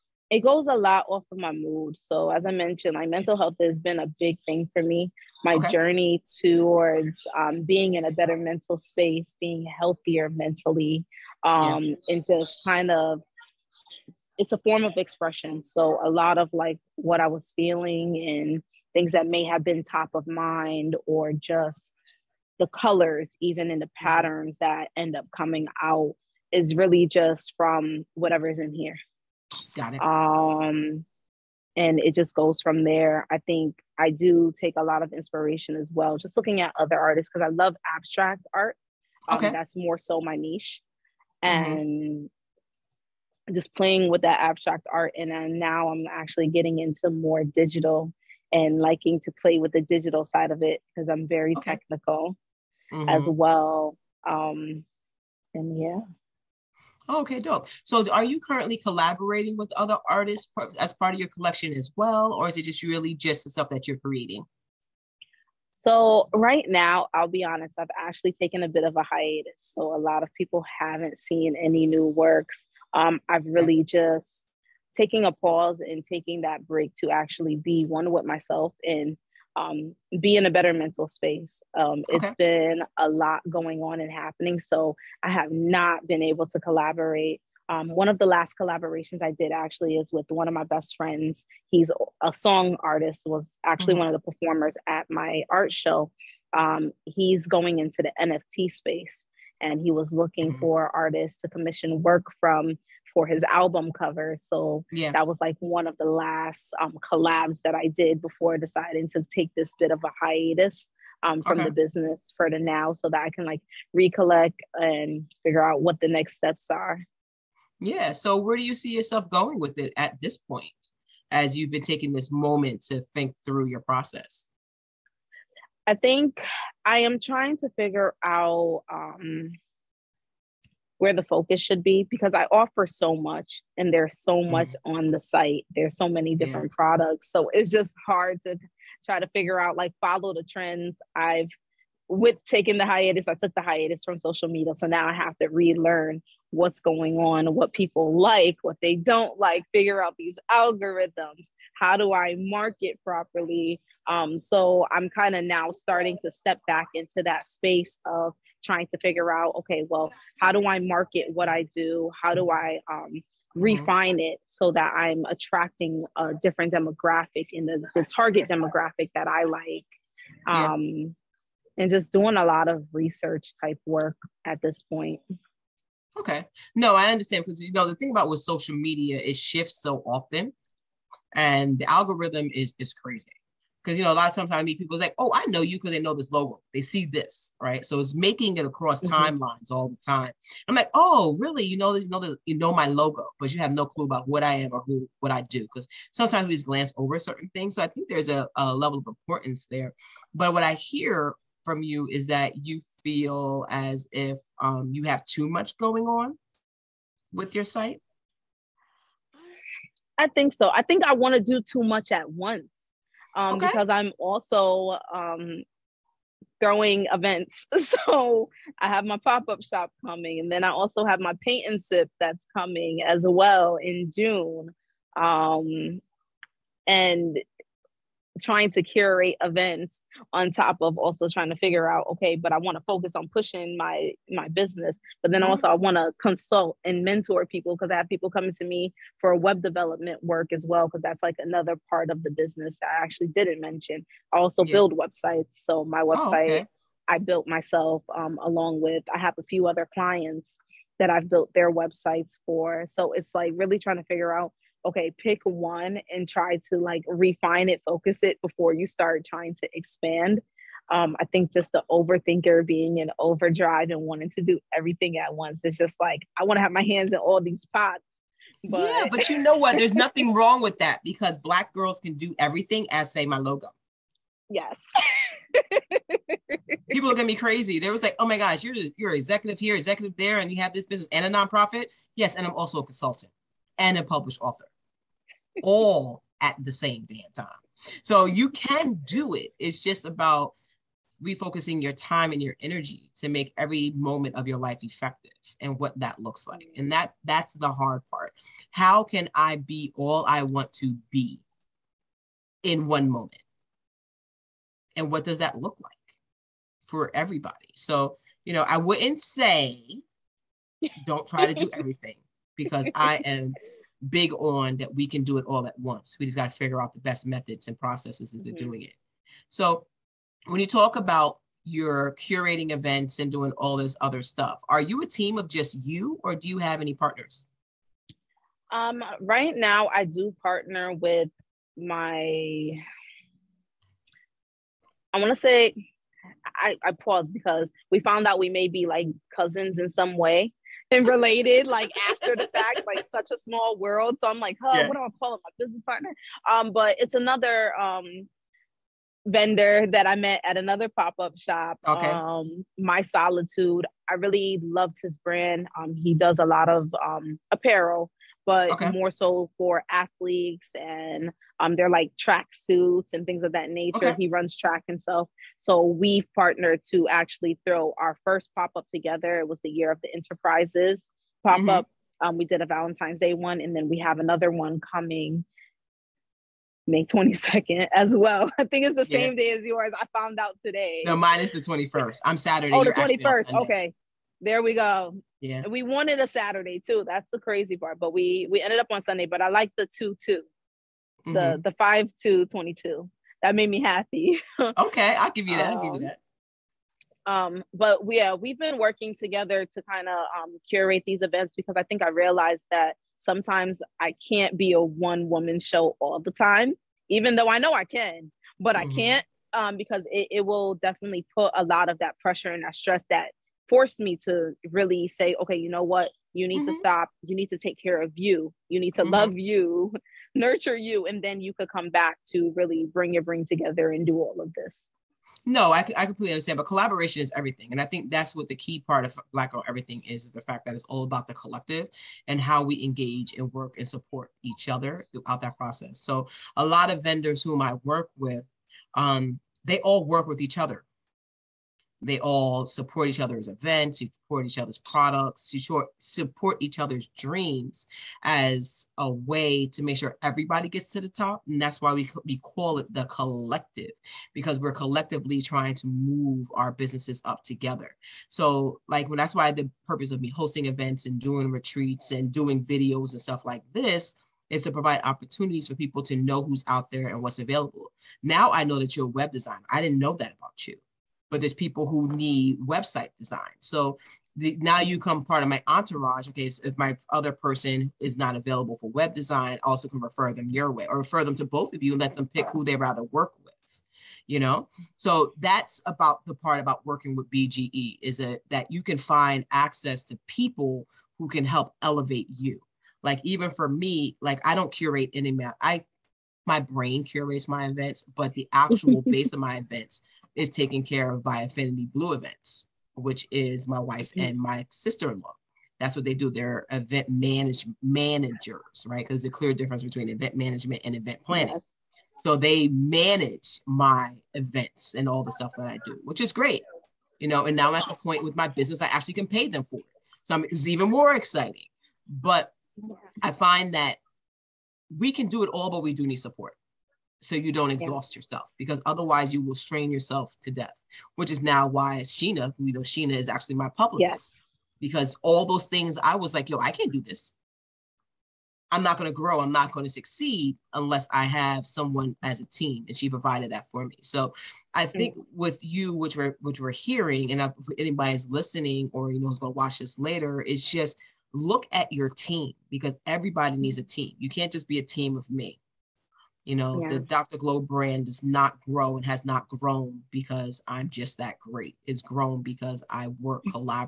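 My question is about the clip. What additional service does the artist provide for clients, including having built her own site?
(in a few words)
web development.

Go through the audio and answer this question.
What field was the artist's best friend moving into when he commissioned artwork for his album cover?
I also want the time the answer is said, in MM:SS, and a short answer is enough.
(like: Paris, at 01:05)
NFT space, at 01:38.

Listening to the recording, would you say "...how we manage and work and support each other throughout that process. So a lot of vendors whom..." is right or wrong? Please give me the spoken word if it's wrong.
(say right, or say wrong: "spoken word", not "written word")
wrong: "engage", not "manage".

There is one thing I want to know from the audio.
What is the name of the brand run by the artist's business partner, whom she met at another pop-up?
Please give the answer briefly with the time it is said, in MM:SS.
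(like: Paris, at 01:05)
My Solitude, at 05:52.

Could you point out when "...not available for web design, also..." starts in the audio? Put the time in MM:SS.
07:58.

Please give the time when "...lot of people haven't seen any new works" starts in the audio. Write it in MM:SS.
01:10.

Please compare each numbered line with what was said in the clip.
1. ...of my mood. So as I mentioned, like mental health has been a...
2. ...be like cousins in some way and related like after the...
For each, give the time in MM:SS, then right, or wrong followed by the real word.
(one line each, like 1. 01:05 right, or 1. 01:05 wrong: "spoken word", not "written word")
1. 00:01 right
2. 05:38 right.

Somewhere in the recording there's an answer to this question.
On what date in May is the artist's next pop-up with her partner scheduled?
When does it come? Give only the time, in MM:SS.
06:16.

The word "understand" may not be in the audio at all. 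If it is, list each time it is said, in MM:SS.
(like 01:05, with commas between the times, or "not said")
02:57, 07:06.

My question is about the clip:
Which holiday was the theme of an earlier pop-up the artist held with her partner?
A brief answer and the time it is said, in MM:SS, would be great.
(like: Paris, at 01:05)
Valentine's Day, at 06:12.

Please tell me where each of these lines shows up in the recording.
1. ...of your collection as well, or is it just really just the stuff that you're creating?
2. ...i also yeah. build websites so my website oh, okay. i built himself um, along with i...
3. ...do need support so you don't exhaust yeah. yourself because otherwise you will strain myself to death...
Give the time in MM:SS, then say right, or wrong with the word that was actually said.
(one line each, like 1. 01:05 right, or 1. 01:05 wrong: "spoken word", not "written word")
1. 01:01 right
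2. 04:04 wrong: "myself", not "himself"
3. 08:45 wrong: "yourself", not "myself".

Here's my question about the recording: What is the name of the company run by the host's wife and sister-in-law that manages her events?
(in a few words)
Affinity Blue Events.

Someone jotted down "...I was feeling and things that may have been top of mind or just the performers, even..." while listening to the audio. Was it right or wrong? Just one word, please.
wrong.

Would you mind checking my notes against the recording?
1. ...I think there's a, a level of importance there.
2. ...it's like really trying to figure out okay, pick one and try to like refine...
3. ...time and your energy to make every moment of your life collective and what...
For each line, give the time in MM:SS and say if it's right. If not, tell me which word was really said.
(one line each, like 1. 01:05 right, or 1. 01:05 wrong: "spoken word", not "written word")
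1. 03:17 right
2. 04:13 right
3. 04:51 wrong: "effective", not "collective".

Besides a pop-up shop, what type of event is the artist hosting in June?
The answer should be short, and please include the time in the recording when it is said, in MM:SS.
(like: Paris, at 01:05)
paint and sip, at 03:41.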